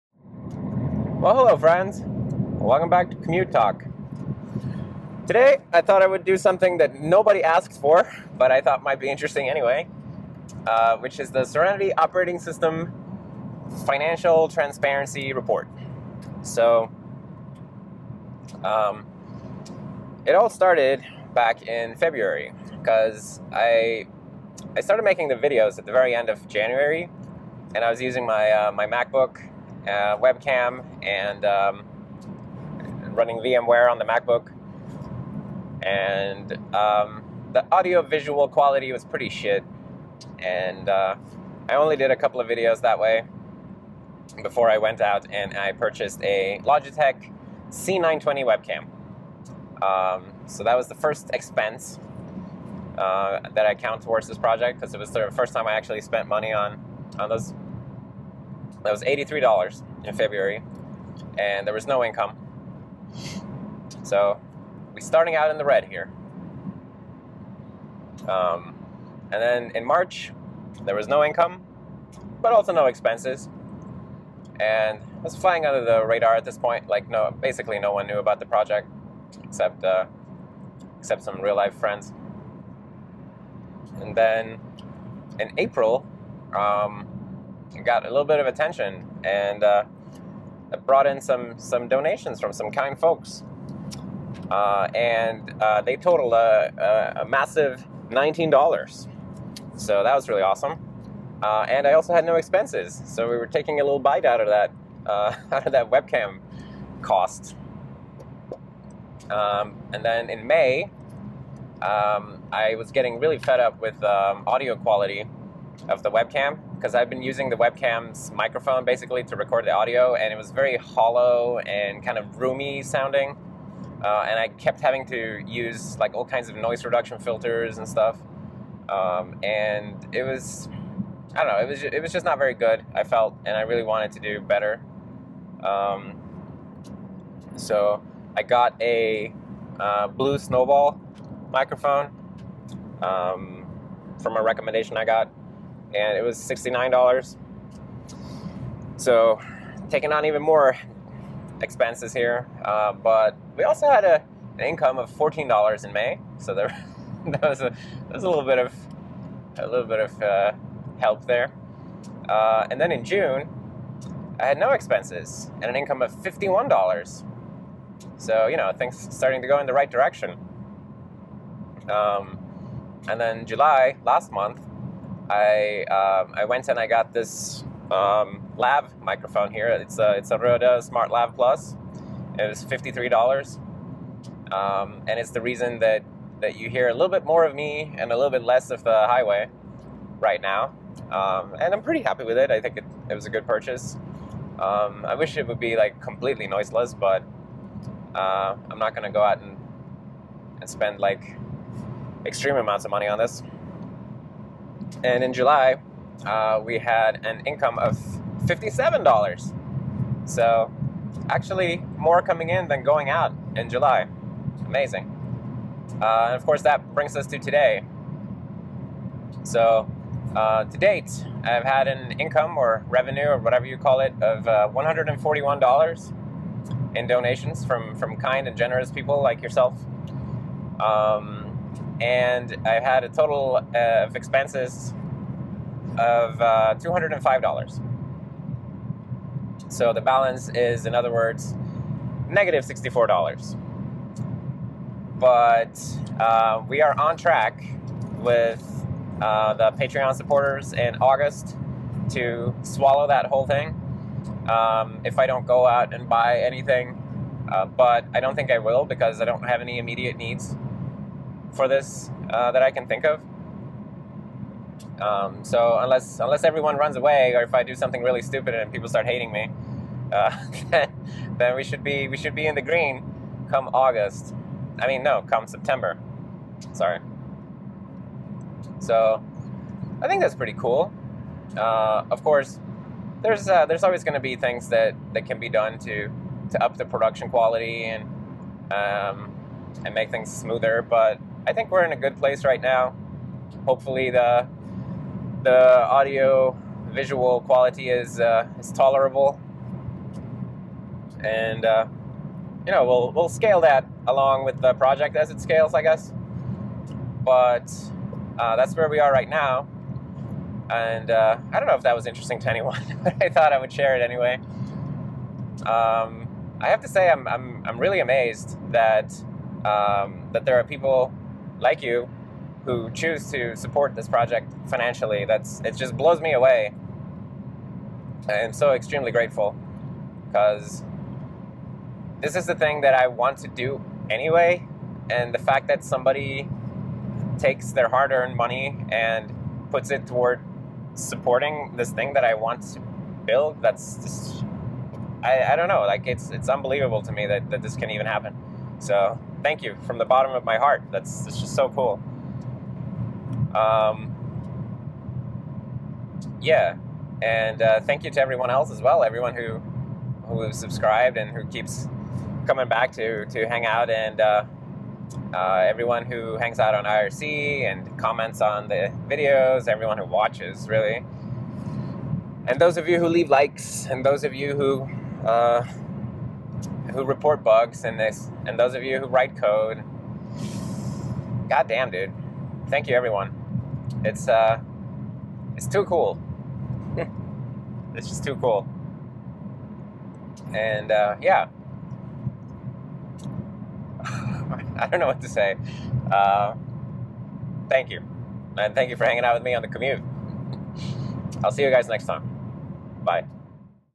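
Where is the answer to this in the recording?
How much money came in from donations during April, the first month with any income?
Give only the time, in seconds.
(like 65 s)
98 s.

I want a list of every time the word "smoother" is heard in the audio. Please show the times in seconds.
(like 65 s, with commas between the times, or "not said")
290 s.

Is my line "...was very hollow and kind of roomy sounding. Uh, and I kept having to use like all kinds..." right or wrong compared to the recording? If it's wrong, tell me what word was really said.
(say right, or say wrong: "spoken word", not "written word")
right.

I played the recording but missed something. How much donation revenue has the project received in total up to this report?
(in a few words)
$141.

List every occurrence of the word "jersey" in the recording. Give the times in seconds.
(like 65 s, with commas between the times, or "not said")
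not said.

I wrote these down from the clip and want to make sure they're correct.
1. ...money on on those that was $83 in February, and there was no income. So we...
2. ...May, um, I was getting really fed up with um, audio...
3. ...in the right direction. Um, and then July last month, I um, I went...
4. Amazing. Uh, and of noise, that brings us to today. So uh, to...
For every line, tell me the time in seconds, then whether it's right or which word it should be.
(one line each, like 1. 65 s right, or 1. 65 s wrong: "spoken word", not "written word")
1. 56 s right
2. 110 s right
3. 169 s right
4. 214 s wrong: "course", not "noise".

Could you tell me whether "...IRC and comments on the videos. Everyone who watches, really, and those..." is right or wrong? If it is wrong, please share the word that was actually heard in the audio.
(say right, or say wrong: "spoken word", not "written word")
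right.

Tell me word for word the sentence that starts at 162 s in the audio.
Uh, and then in June, I had no expenses and an income of $51.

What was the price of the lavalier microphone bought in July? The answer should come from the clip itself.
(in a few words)
$53.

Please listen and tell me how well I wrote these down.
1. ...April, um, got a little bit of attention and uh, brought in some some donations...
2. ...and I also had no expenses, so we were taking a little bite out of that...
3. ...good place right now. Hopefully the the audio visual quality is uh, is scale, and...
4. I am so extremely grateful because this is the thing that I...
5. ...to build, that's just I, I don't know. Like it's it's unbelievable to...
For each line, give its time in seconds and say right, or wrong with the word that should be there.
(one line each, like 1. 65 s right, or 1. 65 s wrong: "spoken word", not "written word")
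1. 85 s right
2. 101 s right
3. 291 s wrong: "tolerable", not "scale"
4. 328 s right
5. 342 s right.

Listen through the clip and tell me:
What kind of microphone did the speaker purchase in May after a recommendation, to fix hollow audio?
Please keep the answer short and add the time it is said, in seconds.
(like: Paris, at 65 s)
Blue Snowball, at 140 s.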